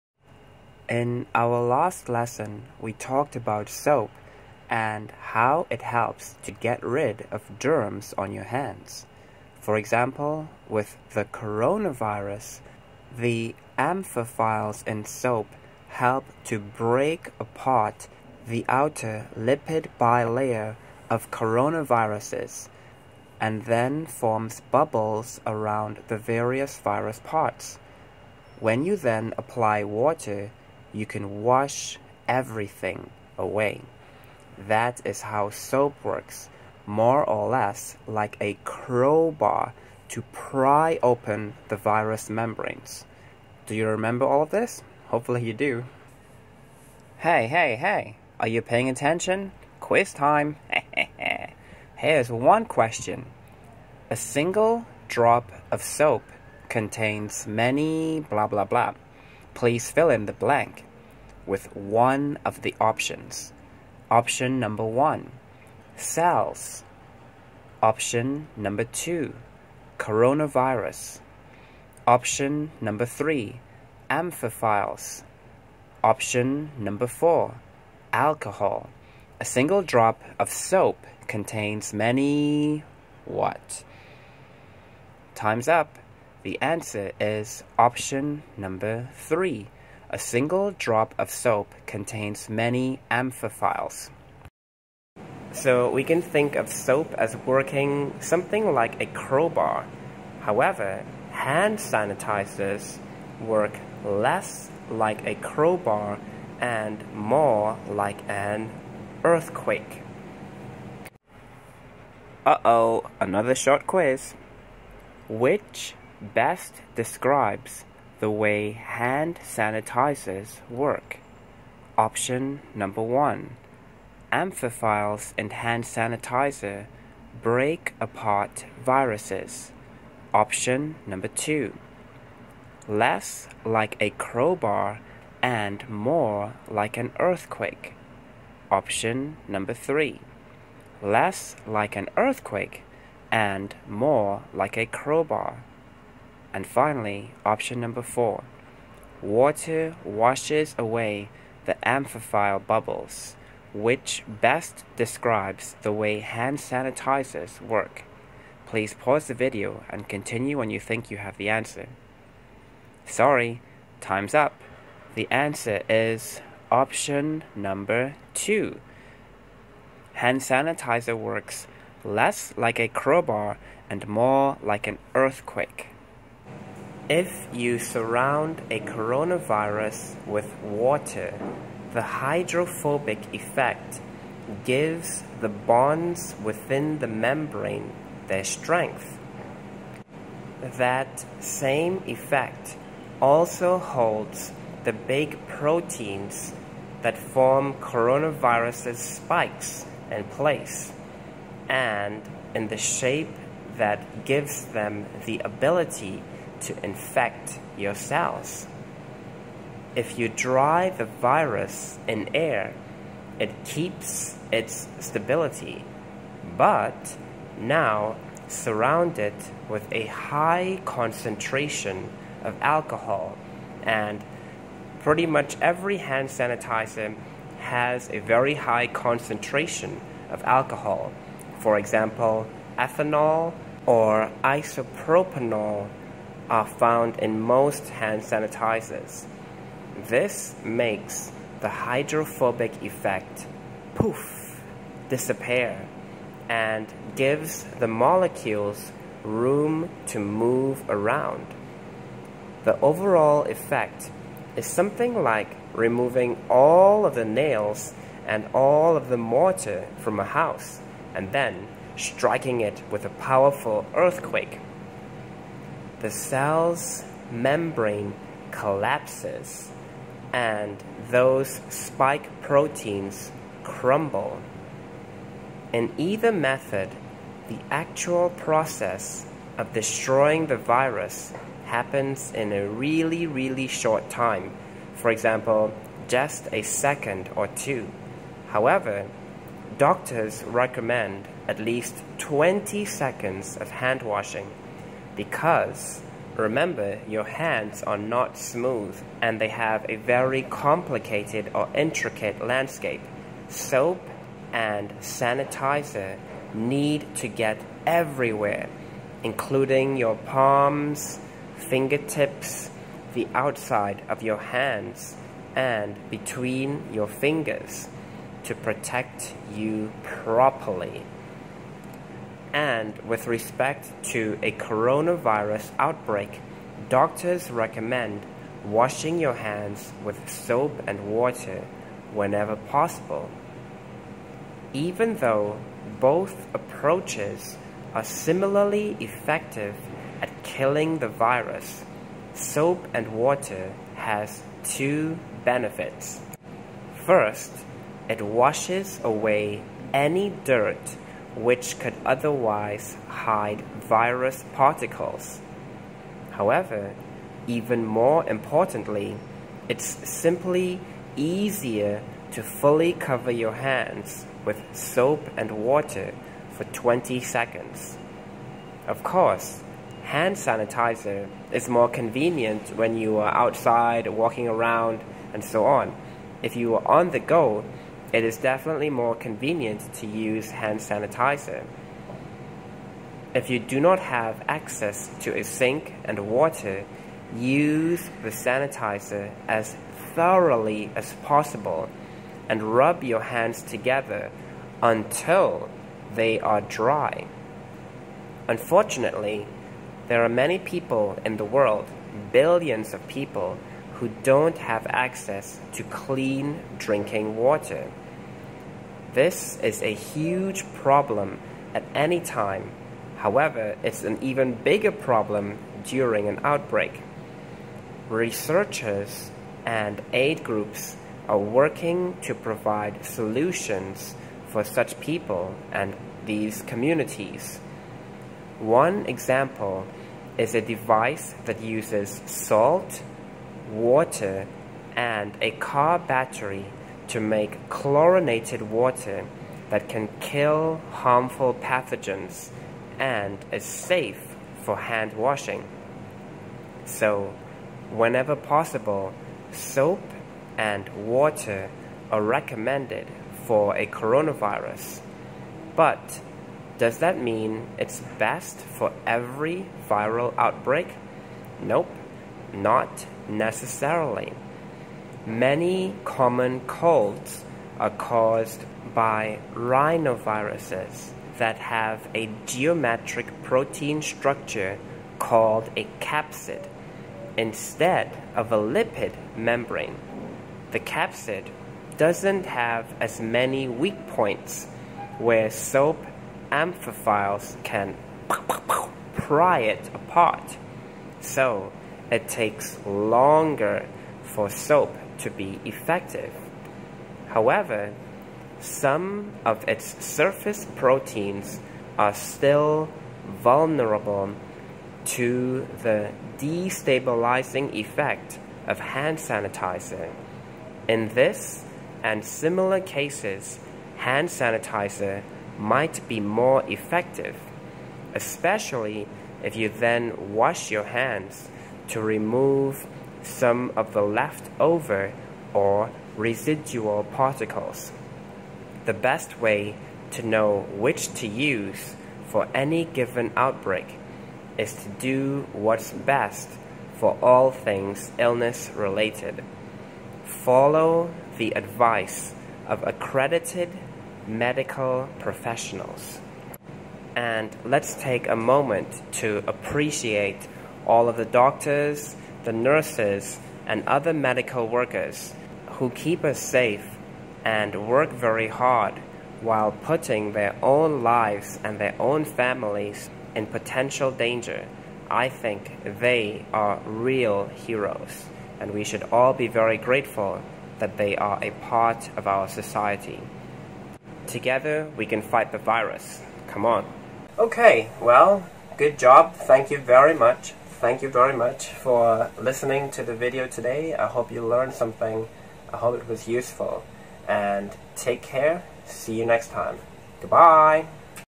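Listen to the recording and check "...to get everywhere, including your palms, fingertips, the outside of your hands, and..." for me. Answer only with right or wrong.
right.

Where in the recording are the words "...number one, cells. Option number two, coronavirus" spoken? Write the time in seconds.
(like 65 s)
64 s.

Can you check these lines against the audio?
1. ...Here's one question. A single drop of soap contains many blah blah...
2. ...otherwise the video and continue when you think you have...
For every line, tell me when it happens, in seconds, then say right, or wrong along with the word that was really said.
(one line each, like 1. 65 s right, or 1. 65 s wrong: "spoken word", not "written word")
1. 51 s right
2. 158 s wrong: "pause", not "otherwise".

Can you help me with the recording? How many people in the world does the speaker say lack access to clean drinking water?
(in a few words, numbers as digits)
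billions.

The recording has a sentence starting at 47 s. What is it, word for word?
Hey, hey, hey, are you paying attention?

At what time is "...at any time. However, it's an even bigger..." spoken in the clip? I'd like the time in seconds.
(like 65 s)
411 s.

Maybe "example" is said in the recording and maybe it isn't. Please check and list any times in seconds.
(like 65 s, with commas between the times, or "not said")
9 s, 231 s, 285 s, 429 s.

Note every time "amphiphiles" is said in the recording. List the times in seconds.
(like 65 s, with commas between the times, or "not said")
13 s, 74 s, 93 s, 124 s, 151 s, 486 s.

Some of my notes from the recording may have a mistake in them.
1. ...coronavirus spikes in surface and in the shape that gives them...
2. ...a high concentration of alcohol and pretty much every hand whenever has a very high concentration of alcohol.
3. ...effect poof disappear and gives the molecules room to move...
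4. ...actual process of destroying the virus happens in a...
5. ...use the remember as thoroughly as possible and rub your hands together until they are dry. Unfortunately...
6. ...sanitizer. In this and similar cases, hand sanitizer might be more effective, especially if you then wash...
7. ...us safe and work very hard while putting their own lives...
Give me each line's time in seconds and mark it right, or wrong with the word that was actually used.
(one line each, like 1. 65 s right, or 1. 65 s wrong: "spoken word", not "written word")
1. 197 s wrong: "place", not "surface"
2. 219 s wrong: "sanitizer", not "whenever"
3. 242 s right
4. 277 s right
5. 387 s wrong: "sanitizer", not "remember"
6. 509 s right
7. 556 s right.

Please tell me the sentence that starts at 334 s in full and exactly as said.
Even though both approaches are similarly effective at killing the virus, soap and water has two benefits.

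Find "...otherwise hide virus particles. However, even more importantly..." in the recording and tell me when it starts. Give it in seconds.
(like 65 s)
352 s.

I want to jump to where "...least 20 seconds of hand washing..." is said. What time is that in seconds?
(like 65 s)
291 s.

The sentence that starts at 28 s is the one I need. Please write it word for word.
When you then apply water, you can wash everything away.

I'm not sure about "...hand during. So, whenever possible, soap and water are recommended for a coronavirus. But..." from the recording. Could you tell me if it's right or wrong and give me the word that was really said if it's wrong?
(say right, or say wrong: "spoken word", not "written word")
wrong: "washing", not "during".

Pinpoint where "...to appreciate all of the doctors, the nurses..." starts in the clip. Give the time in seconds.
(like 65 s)
549 s.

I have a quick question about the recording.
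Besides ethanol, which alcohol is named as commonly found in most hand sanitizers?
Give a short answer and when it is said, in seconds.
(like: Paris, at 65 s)
isopropanol, at 234 s.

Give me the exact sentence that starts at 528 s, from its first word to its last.
The best way to know which to use for any given outbreak is to do what's best for all things illness related.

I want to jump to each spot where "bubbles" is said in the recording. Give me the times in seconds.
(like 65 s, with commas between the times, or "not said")
24 s, 152 s.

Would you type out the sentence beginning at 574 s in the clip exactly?
Together, we can fight the virus.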